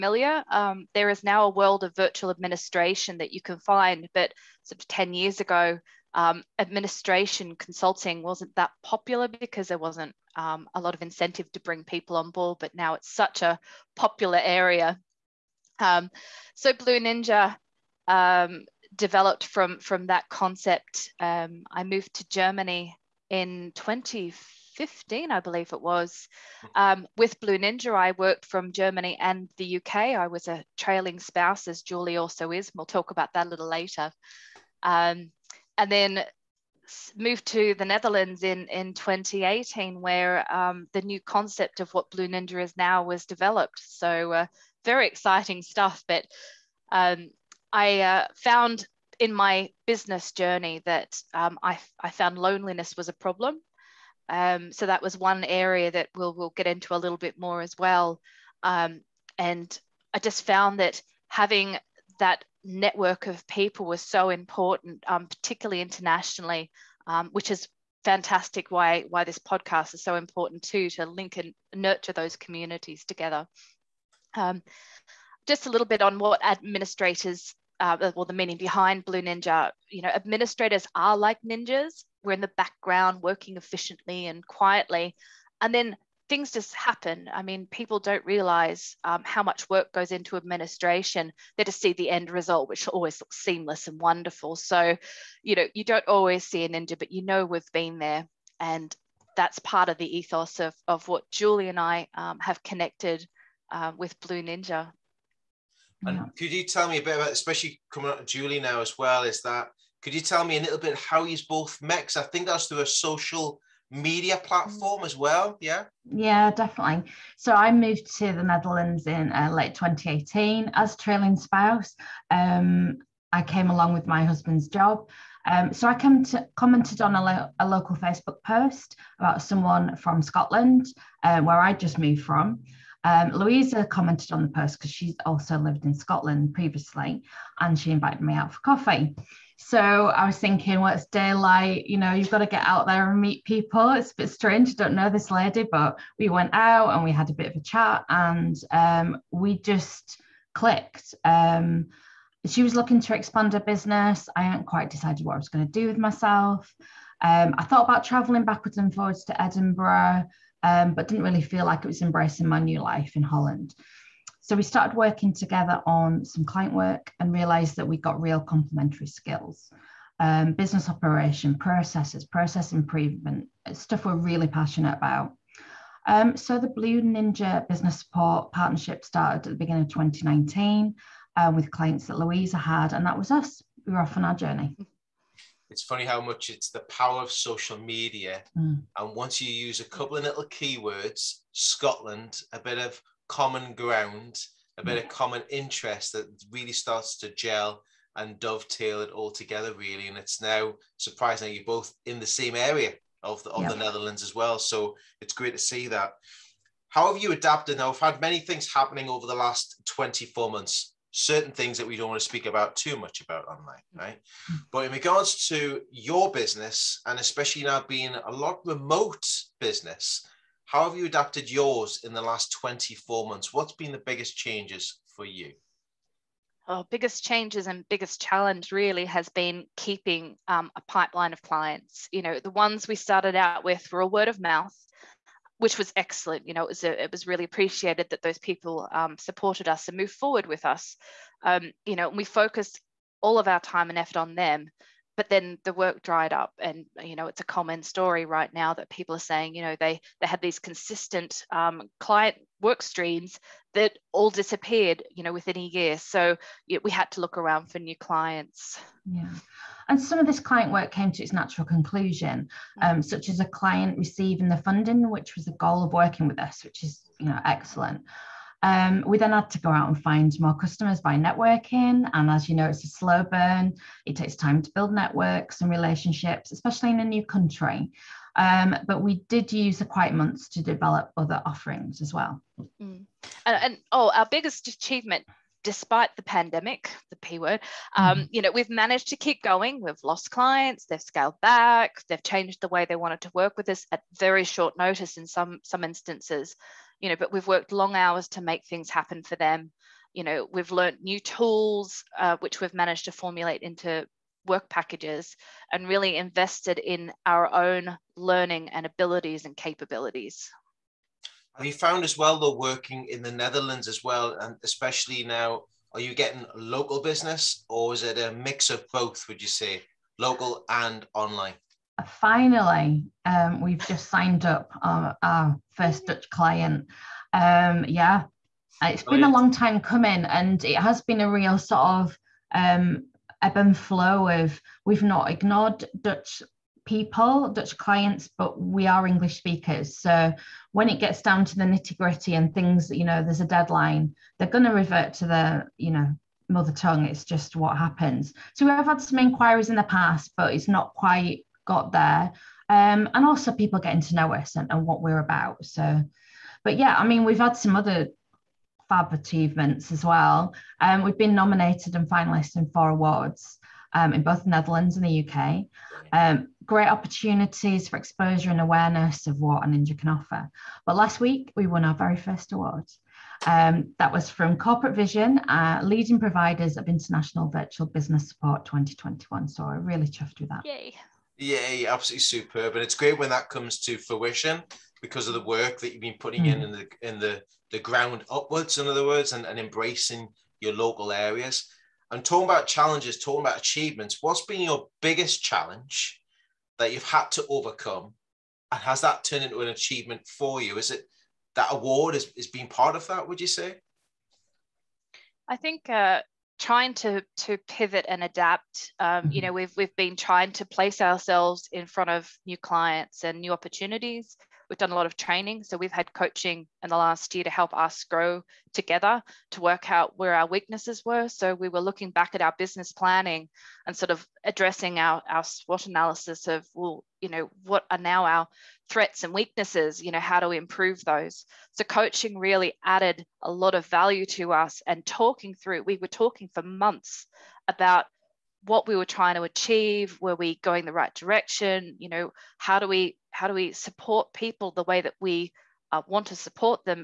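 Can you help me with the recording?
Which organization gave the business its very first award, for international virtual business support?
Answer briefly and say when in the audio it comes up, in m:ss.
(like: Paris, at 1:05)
Corporate Vision, at 6:14.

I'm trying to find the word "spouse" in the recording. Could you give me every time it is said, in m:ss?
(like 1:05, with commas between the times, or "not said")
0:31, 2:01.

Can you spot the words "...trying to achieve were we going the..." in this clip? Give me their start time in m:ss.
7:19.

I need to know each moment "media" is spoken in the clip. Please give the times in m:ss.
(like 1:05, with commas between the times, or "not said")
1:53, 3:07.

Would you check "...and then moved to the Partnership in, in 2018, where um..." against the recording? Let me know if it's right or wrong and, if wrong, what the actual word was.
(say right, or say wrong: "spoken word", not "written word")
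wrong: "Netherlands", not "Partnership".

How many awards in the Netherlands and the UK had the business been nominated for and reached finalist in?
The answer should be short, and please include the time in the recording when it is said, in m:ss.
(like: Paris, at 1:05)
4, at 6:02.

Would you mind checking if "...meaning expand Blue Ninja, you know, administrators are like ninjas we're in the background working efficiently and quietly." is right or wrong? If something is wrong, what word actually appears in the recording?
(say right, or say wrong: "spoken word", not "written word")
wrong: "behind", not "expand".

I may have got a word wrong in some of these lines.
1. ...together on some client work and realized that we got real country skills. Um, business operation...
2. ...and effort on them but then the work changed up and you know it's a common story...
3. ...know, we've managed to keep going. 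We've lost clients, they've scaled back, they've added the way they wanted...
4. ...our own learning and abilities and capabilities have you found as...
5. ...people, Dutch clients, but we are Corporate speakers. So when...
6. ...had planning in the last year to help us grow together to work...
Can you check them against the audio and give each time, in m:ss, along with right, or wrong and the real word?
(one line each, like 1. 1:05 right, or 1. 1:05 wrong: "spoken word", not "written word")
1. 2:45 wrong: "complementary", not "country"
2. 4:03 wrong: "dried", not "changed"
3. 4:48 wrong: "changed", not "added"
4. 5:07 right
5. 5:36 wrong: "English", not "Corporate"
6. 6:55 wrong: "coaching", not "planning".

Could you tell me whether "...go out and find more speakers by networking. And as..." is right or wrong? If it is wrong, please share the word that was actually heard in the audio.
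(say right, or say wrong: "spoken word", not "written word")
wrong: "customers", not "speakers".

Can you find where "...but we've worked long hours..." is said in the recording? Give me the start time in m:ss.
4:57.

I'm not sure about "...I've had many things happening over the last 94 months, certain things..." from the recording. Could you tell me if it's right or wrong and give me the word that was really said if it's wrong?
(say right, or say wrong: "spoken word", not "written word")
wrong: "24", not "94".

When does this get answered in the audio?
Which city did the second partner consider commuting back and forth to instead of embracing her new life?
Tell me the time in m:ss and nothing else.
2:39.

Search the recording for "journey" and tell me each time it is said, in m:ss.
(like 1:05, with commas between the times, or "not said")
0:50, 3:04.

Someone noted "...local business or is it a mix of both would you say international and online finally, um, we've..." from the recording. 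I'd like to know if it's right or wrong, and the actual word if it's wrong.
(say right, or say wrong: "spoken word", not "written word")
wrong: "local", not "international".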